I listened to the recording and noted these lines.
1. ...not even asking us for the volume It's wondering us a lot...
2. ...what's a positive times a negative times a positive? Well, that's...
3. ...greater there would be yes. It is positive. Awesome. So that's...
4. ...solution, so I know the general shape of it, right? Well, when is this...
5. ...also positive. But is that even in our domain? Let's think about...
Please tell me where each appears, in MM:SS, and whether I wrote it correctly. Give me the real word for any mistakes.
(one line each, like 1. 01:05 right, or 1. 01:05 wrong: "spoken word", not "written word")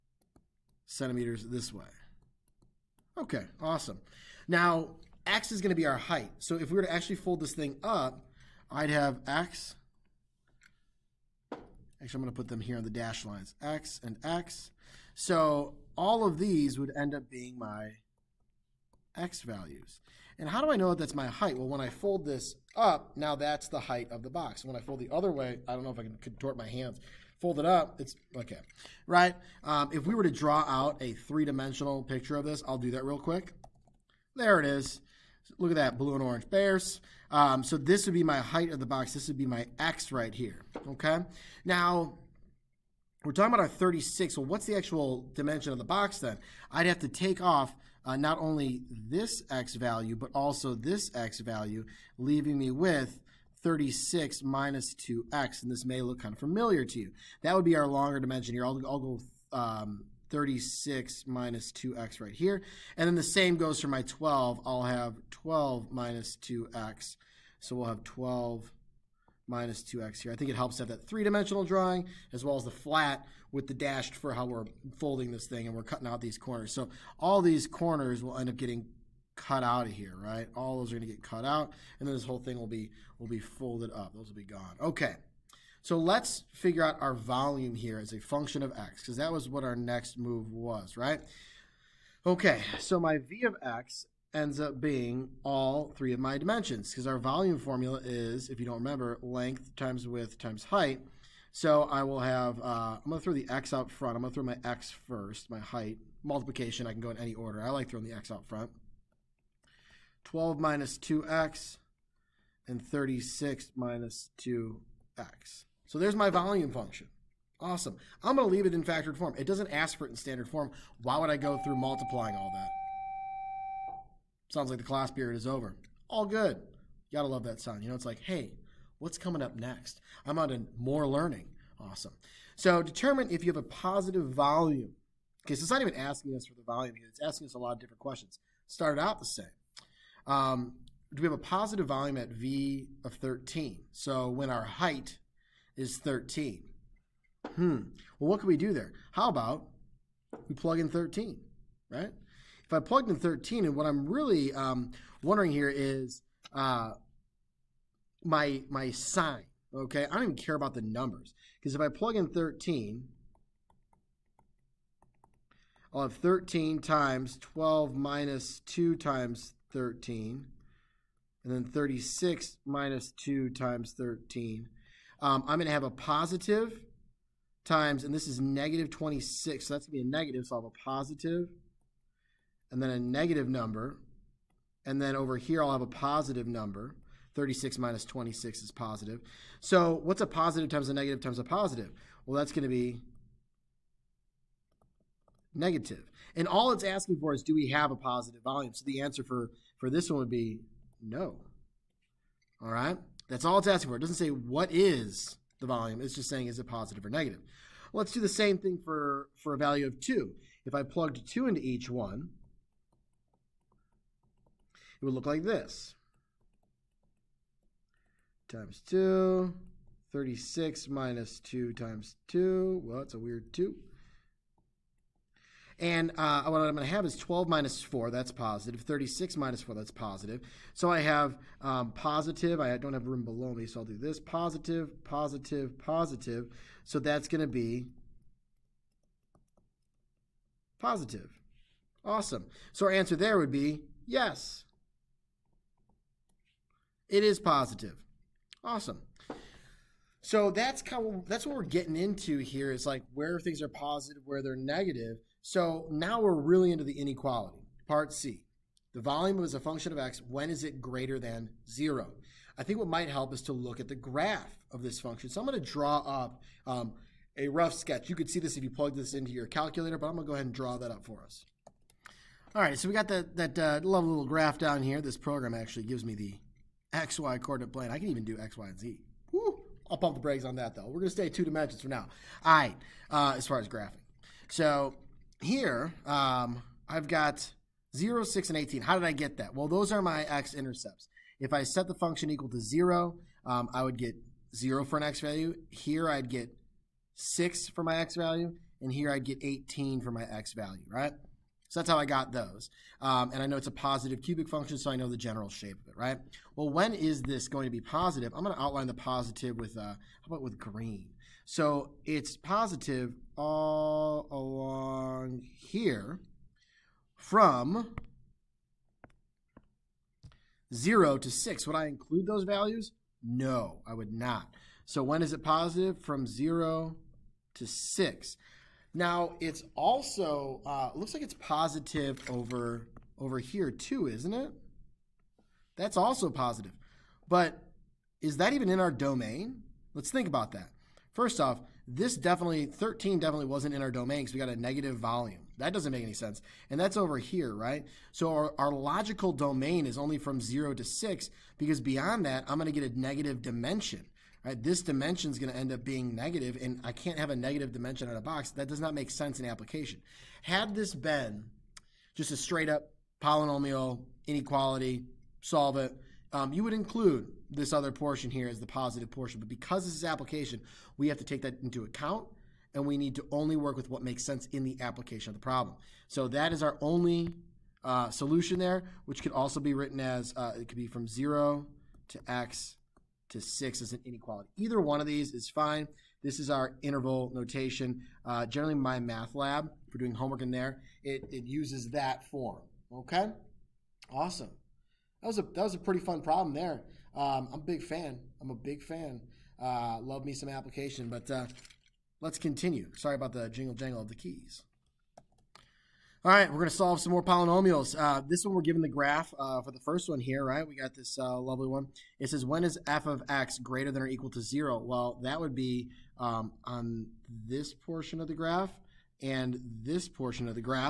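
1. 02:15 wrong: "asking", not "wondering"
2. 03:10 right
3. 04:02 wrong: "answer", not "greater"
4. 05:04 wrong: "function", not "solution"
5. 05:35 right.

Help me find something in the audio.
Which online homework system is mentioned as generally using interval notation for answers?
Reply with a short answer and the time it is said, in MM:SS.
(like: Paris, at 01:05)
MyMathLab, at 06:28.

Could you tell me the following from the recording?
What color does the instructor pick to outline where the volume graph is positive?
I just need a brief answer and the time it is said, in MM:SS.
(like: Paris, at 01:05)
green, at 05:10.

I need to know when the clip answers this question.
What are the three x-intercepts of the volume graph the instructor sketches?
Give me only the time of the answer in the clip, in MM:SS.
04:47.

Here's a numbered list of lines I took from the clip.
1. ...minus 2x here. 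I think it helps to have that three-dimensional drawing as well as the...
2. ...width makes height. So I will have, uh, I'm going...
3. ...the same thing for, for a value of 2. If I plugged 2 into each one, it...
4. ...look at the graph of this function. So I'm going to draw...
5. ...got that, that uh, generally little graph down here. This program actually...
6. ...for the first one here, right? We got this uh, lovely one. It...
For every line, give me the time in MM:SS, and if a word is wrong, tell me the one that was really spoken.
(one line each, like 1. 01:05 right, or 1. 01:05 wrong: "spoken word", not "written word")
1. 01:09 right
2. 01:40 wrong: "times", not "makes"
3. 03:28 right
4. 04:23 right
5. 04:32 wrong: "lovely", not "generally"
6. 06:49 right.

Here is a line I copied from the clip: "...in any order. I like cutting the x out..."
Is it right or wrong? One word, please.
wrong.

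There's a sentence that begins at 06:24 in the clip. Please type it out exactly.
Either one of these is fine.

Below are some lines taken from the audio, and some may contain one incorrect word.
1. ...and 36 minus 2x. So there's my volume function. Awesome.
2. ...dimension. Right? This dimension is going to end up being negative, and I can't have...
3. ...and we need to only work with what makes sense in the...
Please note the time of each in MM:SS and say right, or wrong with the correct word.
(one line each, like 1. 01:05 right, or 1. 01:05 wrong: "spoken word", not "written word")
1. 01:52 right
2. 05:53 right
3. 06:12 right.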